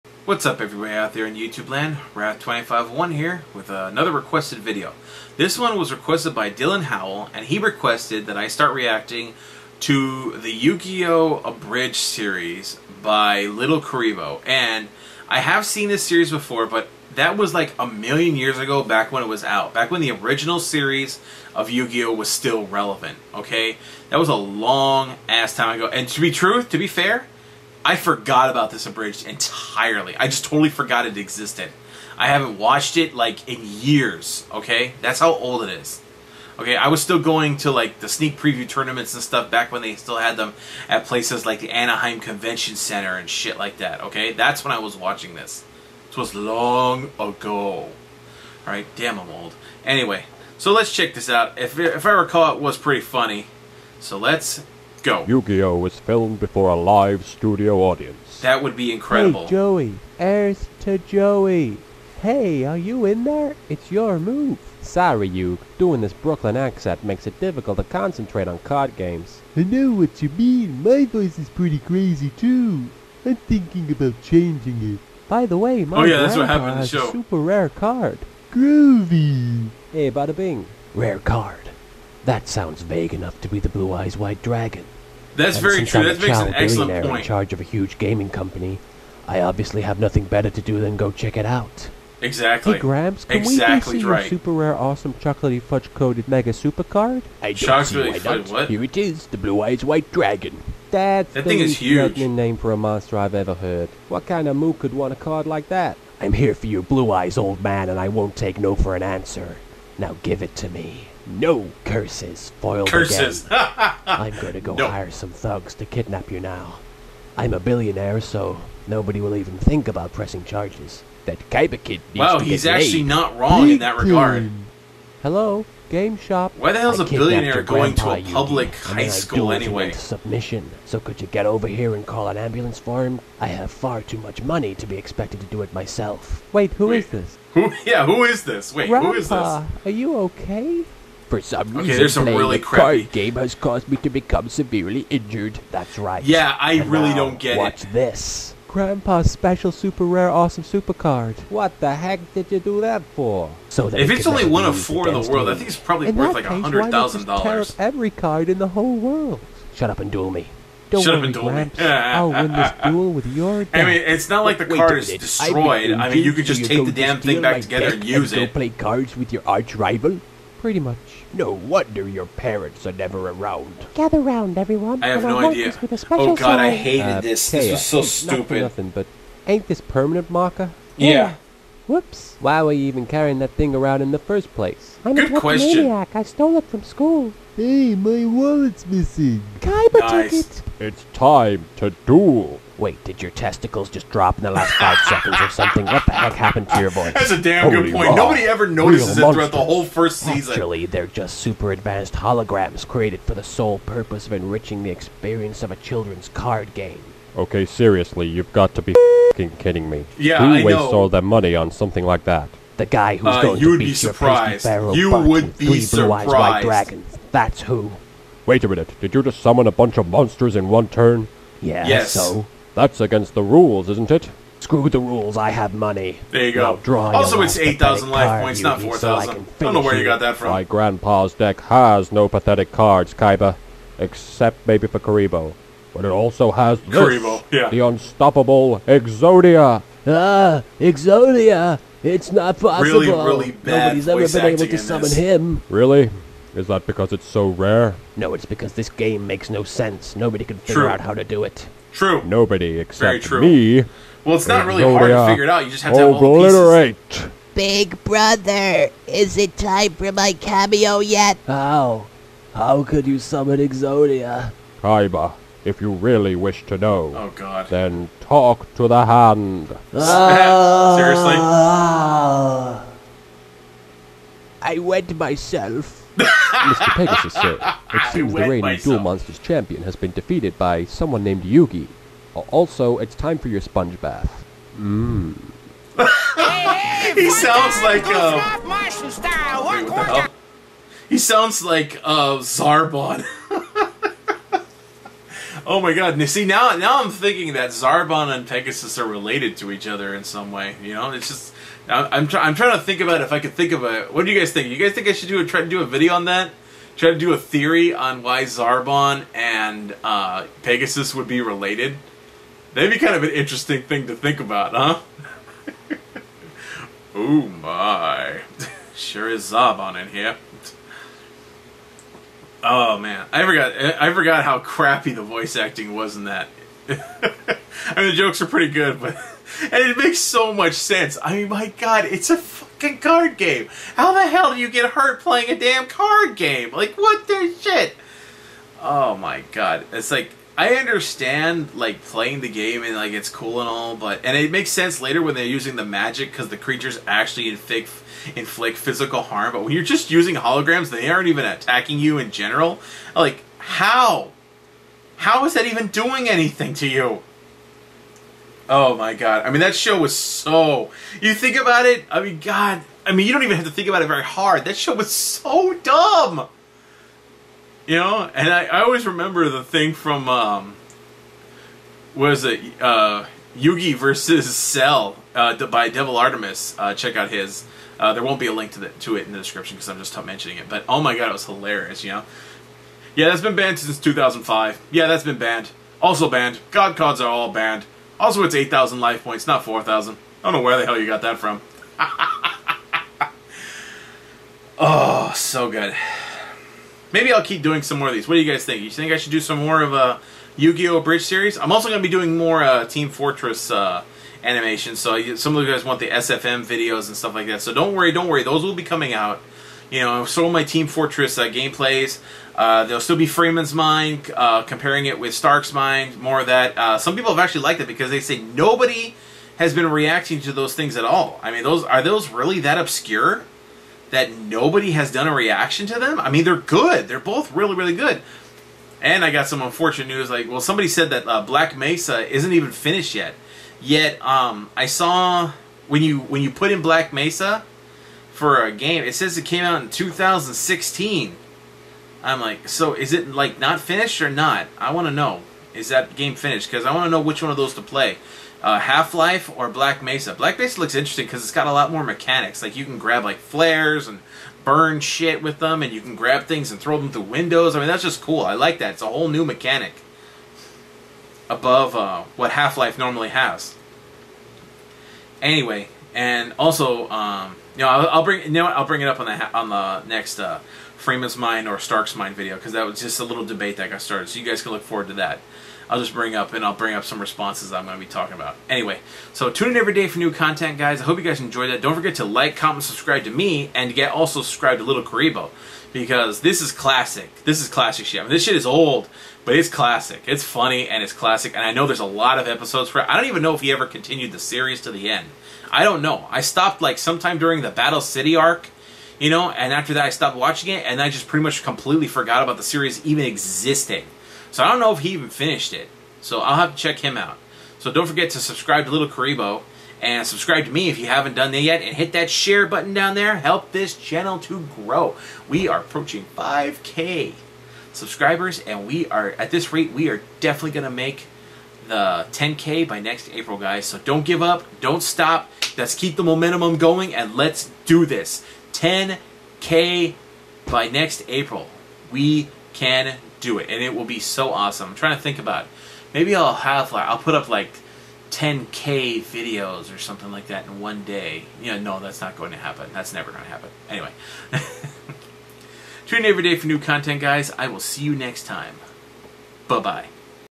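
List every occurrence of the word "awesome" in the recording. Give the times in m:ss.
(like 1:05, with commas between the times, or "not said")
1:34, 2:30, 8:54.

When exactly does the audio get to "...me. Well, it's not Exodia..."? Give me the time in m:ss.
4:13.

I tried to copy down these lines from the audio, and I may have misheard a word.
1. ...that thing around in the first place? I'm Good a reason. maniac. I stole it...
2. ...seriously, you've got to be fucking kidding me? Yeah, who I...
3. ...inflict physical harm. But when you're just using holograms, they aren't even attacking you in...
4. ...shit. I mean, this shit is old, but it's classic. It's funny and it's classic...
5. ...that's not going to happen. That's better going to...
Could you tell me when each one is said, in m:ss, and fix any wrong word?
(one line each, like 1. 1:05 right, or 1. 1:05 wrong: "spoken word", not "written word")
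1. 3:03 wrong: "question", not "reason"
2. 3:27 right
3. 5:48 right
4. 8:08 right
5. 9:01 wrong: "never", not "better".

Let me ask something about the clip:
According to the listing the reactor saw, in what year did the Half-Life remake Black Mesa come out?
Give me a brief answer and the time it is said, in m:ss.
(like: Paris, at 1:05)
2016, at 7:19.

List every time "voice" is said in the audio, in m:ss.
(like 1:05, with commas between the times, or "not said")
1:11, 3:16, 5:25.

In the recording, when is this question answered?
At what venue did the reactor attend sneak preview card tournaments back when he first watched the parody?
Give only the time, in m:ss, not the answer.
0:41.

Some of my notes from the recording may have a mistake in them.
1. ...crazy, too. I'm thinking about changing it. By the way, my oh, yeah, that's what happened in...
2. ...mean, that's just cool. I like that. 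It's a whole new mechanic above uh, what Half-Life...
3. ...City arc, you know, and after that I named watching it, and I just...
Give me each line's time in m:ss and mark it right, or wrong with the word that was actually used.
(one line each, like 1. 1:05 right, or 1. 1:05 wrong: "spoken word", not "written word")
1. 1:11 right
2. 7:37 right
3. 8:17 wrong: "stopped", not "named".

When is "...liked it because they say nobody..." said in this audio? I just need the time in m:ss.
6:57.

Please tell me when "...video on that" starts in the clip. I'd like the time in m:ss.
5:05.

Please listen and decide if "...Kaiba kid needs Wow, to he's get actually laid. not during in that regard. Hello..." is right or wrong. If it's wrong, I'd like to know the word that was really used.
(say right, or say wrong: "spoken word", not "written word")
wrong: "wrong", not "during".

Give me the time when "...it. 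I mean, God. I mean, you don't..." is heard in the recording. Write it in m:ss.
6:01.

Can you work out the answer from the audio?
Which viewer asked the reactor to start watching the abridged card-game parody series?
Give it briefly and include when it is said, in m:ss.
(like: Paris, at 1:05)
Dylan Howell, at 0:06.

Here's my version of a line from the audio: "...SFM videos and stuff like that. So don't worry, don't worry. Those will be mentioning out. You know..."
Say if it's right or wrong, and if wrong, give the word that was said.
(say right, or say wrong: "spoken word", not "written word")
wrong: "coming", not "mentioning".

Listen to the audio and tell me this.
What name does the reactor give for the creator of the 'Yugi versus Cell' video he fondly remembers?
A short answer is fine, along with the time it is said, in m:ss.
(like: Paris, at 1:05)
Devil Artemis, at 6:15.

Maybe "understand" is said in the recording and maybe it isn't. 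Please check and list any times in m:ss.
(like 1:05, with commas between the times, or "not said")
5:40.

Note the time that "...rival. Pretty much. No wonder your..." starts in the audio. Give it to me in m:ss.
2:49.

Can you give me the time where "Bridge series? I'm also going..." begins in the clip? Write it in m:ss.
6:41.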